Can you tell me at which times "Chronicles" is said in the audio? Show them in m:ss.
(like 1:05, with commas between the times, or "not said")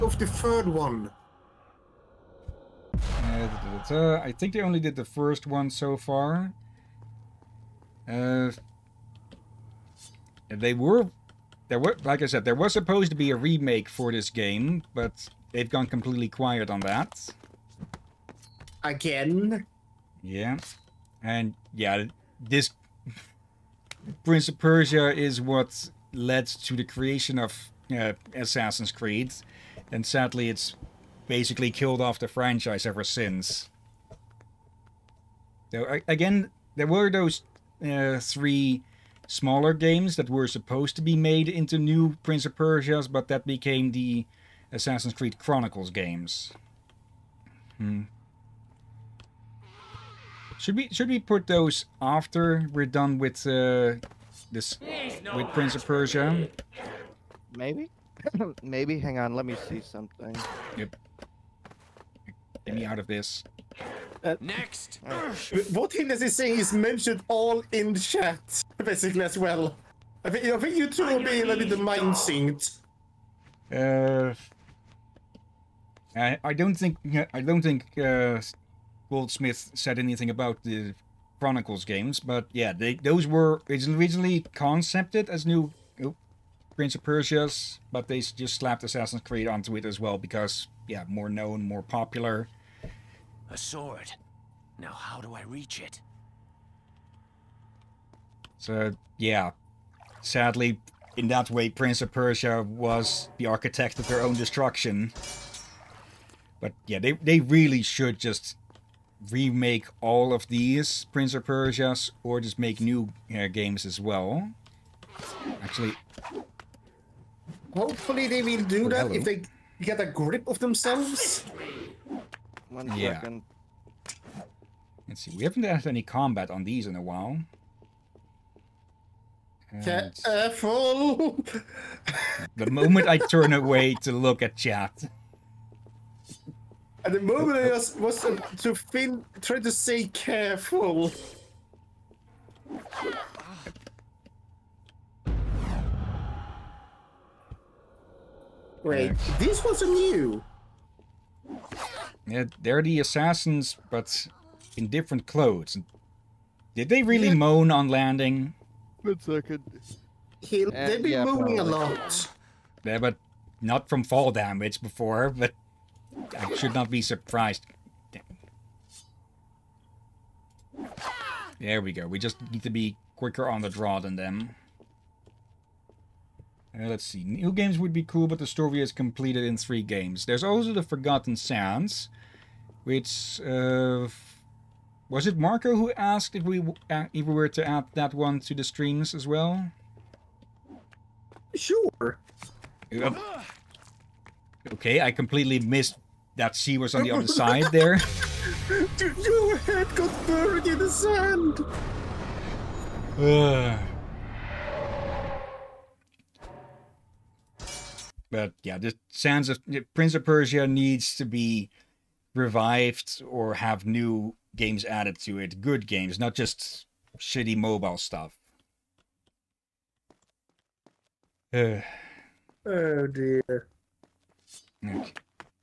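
0:45, 1:21.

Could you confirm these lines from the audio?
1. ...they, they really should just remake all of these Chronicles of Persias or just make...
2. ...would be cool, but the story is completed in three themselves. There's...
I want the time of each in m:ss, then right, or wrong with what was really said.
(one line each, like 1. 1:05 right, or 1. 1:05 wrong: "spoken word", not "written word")
1. 1:46 wrong: "Prince", not "Chronicles"
2. 2:57 wrong: "games", not "themselves".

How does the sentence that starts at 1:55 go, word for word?
Actually, hopefully they will do that hello.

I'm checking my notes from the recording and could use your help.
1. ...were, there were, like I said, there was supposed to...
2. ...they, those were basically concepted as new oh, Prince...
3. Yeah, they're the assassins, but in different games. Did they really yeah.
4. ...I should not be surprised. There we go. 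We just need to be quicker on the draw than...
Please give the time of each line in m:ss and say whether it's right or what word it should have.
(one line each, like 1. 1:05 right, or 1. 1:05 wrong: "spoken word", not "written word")
1. 0:10 right
2. 1:22 wrong: "originally", not "basically"
3. 2:32 wrong: "clothes", not "games"
4. 2:46 right.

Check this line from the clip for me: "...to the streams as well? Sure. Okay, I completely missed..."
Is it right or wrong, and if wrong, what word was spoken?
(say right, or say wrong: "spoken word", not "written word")
right.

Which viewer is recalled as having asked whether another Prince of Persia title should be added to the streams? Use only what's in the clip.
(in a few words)
Marco.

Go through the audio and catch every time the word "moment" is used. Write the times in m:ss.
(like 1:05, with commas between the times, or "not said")
2:12, 2:17.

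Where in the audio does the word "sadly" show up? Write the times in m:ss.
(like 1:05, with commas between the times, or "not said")
0:30, 1:40.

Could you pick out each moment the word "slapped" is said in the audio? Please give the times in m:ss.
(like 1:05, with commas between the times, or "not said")
1:28.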